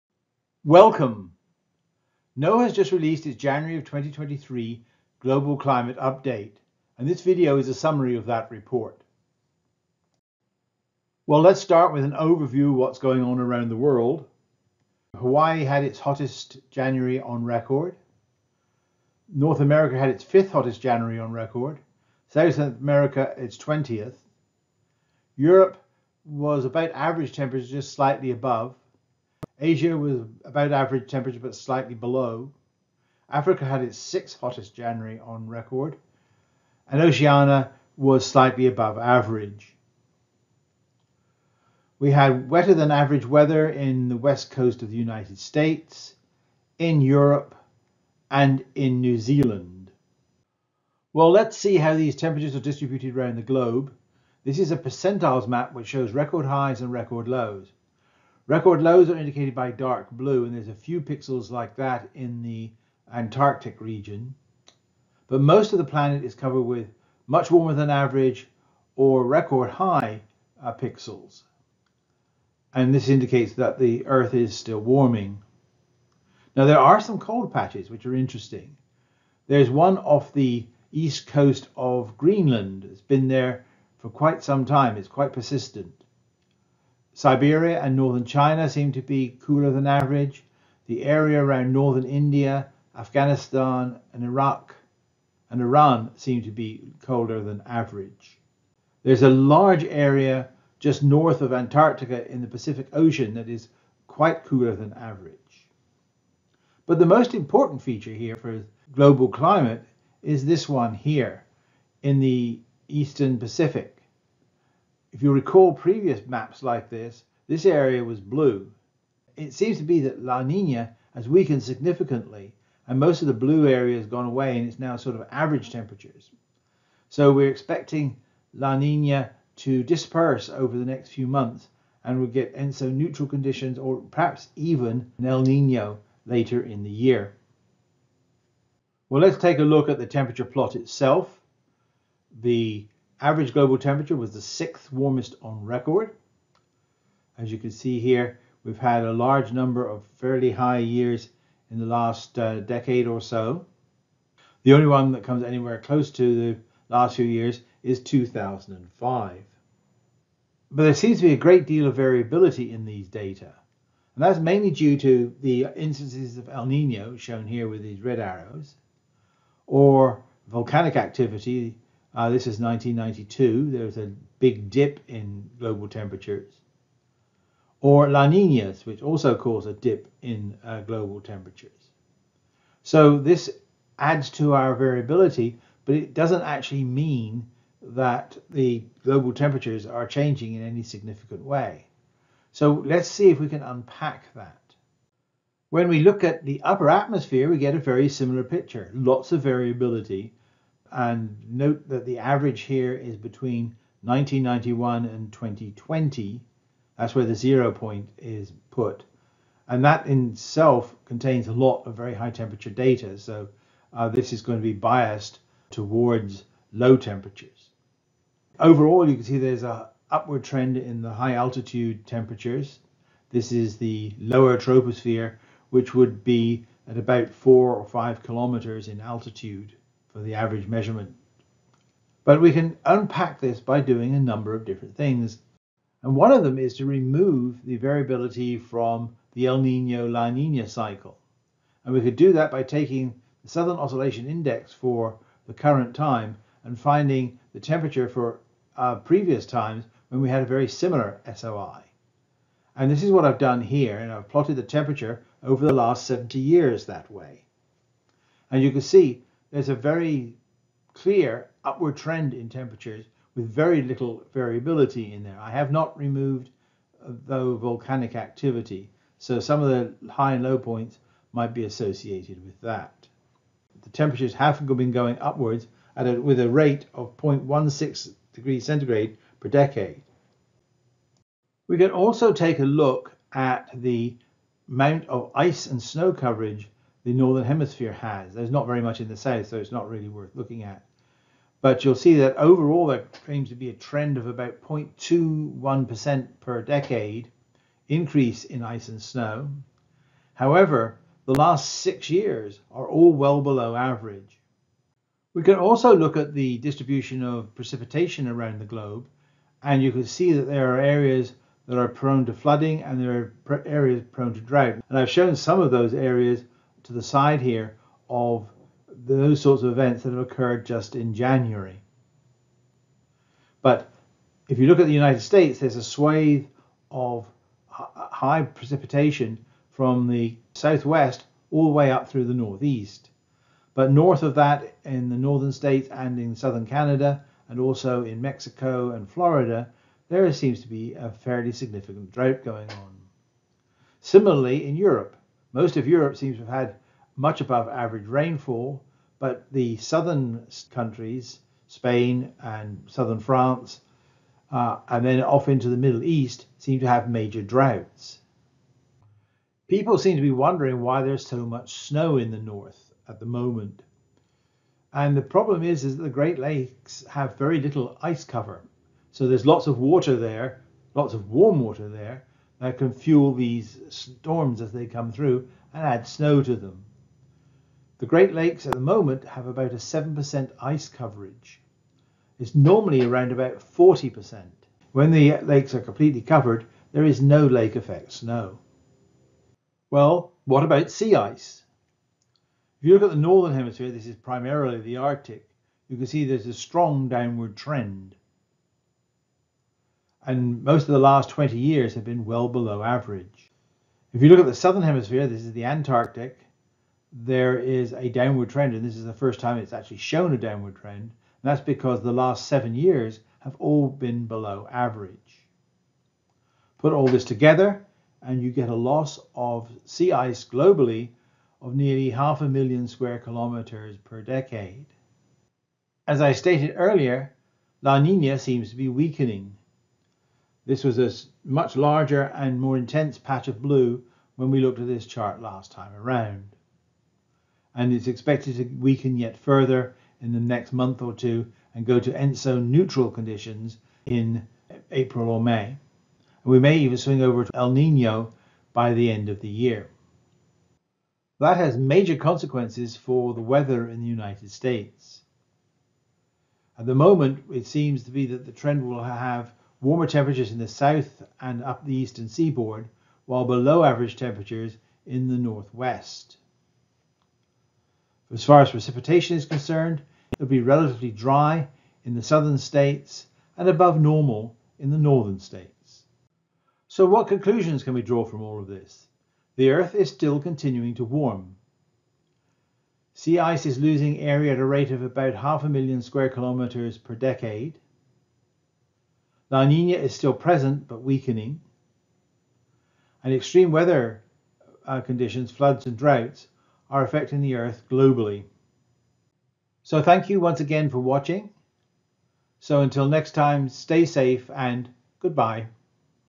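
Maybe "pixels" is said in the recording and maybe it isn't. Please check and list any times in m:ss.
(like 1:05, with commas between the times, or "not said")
1:00, 1:10.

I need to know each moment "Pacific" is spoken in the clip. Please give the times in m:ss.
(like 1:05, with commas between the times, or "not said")
1:42, 1:53.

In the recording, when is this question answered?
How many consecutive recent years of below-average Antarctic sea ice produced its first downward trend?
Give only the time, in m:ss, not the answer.
6:52.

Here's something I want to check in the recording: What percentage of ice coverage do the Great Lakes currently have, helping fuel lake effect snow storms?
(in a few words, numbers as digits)
7%.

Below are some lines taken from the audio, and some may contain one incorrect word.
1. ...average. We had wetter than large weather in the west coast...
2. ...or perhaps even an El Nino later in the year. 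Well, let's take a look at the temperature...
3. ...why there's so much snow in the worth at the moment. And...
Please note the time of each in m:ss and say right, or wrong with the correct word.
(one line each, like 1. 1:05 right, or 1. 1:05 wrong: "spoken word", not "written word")
1. 0:38 wrong: "average", not "large"
2. 2:13 right
3. 6:00 wrong: "north", not "worth".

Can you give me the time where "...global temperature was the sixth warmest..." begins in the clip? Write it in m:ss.
2:23.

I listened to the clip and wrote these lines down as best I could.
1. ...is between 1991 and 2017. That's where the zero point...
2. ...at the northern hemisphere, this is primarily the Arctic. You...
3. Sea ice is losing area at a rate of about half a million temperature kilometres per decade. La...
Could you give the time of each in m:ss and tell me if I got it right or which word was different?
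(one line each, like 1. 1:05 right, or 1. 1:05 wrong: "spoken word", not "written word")
1. 3:22 wrong: "2020", not "2017"
2. 6:33 right
3. 8:03 wrong: "square", not "temperature".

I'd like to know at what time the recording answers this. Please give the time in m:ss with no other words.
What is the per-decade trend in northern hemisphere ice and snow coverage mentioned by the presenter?
4:54.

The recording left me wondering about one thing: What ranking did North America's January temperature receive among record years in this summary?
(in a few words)
5th hottest.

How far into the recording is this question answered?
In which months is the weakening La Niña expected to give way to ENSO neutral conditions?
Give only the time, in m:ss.
7:24.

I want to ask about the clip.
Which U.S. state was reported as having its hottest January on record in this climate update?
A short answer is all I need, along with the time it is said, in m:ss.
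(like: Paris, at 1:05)
Hawaii, at 0:15.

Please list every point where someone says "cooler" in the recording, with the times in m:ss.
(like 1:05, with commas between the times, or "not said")
1:29, 1:44.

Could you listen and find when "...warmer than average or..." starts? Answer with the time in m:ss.
1:07.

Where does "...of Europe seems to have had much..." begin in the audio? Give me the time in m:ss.
5:45.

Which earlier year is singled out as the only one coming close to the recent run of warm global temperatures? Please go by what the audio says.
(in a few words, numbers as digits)
2005.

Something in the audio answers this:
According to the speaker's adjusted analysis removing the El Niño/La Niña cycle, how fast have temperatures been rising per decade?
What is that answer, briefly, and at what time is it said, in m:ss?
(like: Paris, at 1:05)
0.16 degrees centigrade, at 4:37.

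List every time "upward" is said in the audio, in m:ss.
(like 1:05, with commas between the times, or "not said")
3:40, 4:21, 4:35.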